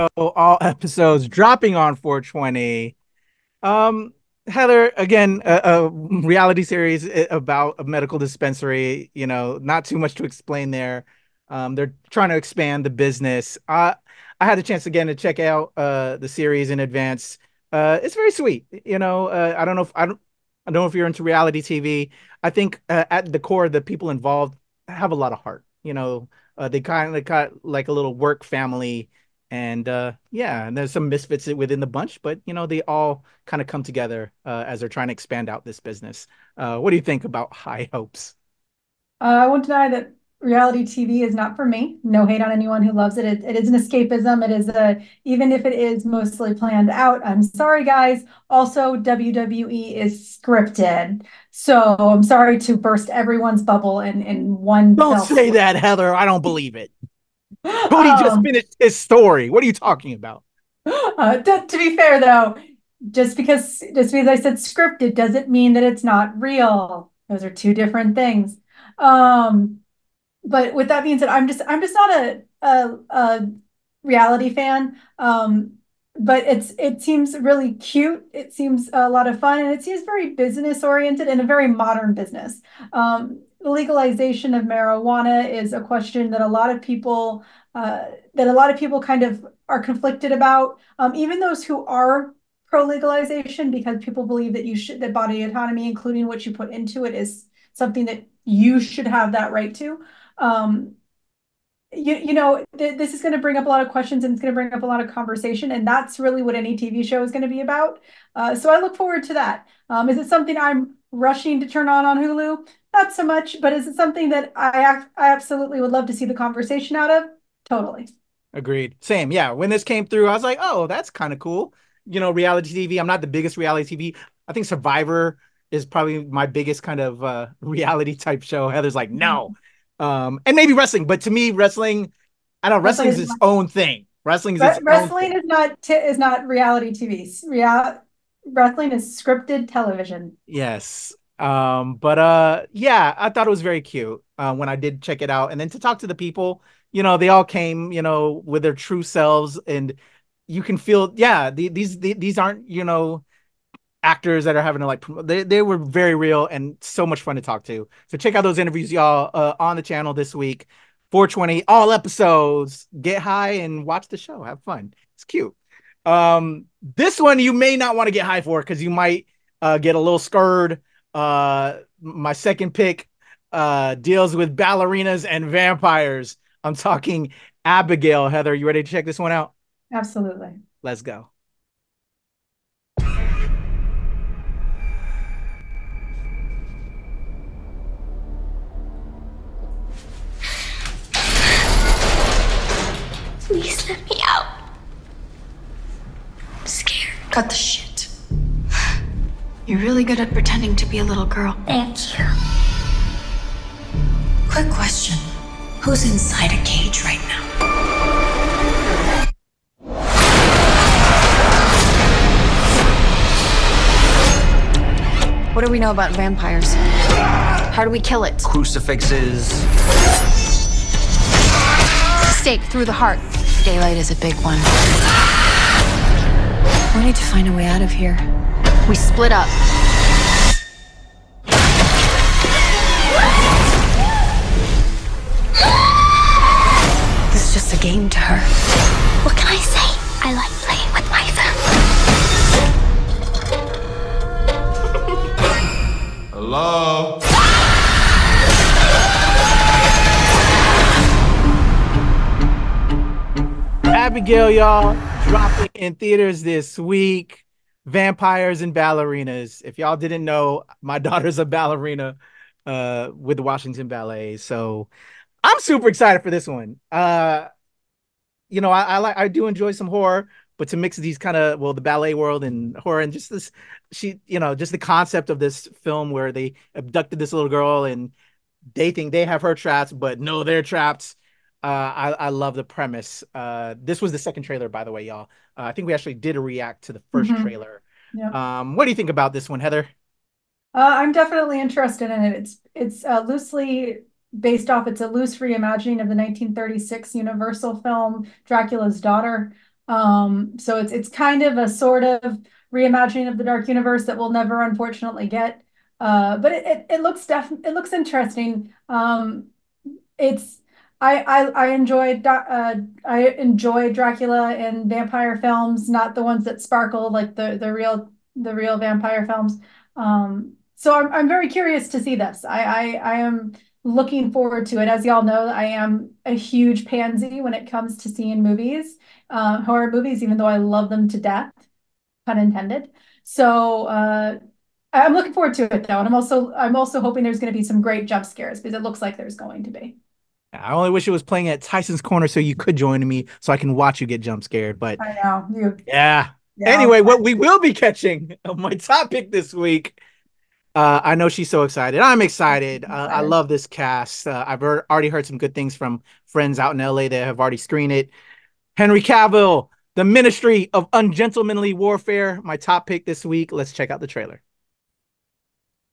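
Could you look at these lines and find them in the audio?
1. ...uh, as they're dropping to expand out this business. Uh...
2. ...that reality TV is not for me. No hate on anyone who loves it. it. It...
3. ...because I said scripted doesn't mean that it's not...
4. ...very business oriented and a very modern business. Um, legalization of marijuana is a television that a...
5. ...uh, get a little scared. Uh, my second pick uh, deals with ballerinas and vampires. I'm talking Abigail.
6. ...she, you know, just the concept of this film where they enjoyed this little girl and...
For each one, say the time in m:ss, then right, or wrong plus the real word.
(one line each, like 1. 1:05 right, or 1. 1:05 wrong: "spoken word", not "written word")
1. 0:34 wrong: "trying", not "dropping"
2. 0:39 right
3. 1:04 right
4. 1:20 wrong: "question", not "television"
5. 2:49 right
6. 4:33 wrong: "abducted", not "enjoyed".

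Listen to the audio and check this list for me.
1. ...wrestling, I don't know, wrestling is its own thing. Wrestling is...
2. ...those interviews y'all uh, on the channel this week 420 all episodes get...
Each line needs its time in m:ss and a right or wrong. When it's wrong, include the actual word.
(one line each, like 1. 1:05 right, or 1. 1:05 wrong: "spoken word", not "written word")
1. 2:11 right
2. 2:38 right.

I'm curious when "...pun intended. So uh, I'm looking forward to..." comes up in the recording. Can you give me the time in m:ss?
5:32.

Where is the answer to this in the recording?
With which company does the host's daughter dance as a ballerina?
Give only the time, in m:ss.
4:23.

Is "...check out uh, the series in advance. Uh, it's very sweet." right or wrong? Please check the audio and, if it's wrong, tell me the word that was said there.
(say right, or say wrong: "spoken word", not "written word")
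right.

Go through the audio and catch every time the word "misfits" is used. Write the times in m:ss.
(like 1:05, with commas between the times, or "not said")
0:31.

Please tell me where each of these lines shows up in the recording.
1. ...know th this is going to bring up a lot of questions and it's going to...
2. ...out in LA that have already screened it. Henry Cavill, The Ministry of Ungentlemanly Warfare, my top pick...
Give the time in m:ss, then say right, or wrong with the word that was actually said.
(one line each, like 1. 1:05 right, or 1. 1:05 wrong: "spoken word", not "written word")
1. 1:42 right
2. 5:56 right.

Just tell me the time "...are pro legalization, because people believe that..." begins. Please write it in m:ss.
1:31.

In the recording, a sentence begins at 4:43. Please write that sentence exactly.
Uh, this was the second trailer, by the way, y'all.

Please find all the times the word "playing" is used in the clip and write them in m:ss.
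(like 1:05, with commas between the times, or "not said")
4:00, 5:41.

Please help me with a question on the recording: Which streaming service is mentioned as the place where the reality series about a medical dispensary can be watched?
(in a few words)
Hulu.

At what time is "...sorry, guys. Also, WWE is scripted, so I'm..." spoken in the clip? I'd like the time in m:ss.
0:47.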